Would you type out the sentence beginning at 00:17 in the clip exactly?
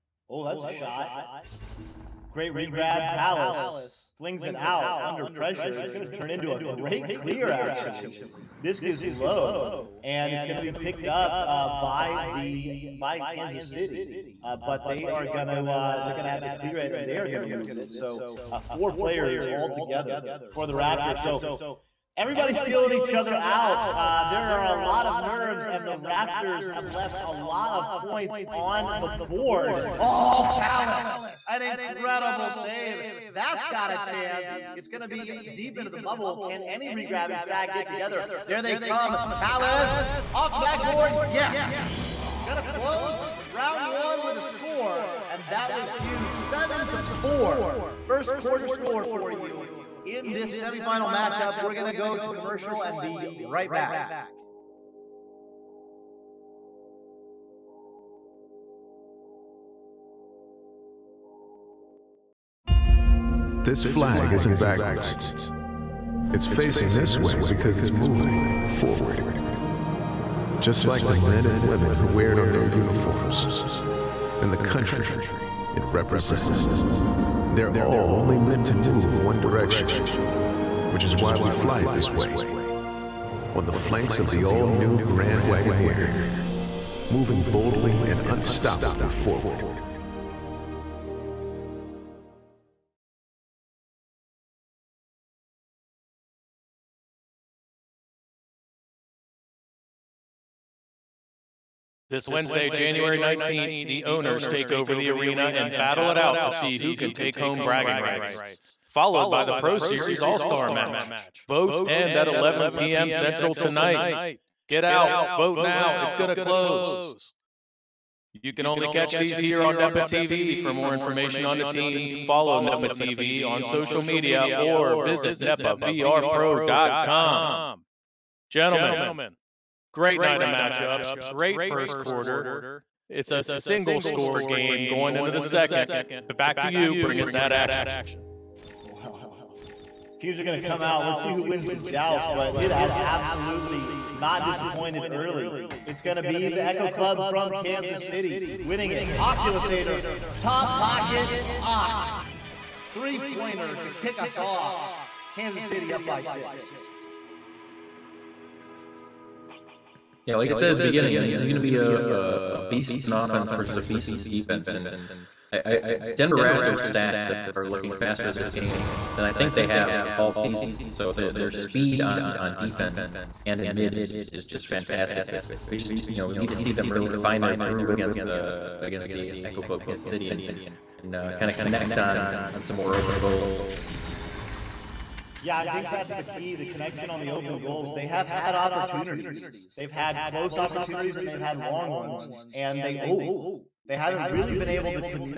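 So uh, four players all together for the Raptors.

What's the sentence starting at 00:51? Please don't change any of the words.
We're going to go to commercial and be right back.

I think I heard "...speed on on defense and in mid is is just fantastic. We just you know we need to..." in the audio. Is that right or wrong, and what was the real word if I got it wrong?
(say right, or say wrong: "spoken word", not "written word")
right.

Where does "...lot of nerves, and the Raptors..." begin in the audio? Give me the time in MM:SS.
00:24.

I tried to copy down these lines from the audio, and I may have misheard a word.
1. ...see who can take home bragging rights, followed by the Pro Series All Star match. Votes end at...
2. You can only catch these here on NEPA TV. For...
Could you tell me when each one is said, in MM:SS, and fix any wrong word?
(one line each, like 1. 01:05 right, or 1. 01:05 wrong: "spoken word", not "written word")
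1. 01:46 right
2. 01:58 right.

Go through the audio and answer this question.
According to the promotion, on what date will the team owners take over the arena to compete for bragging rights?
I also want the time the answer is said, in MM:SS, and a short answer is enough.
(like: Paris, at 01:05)
January 19th, at 01:42.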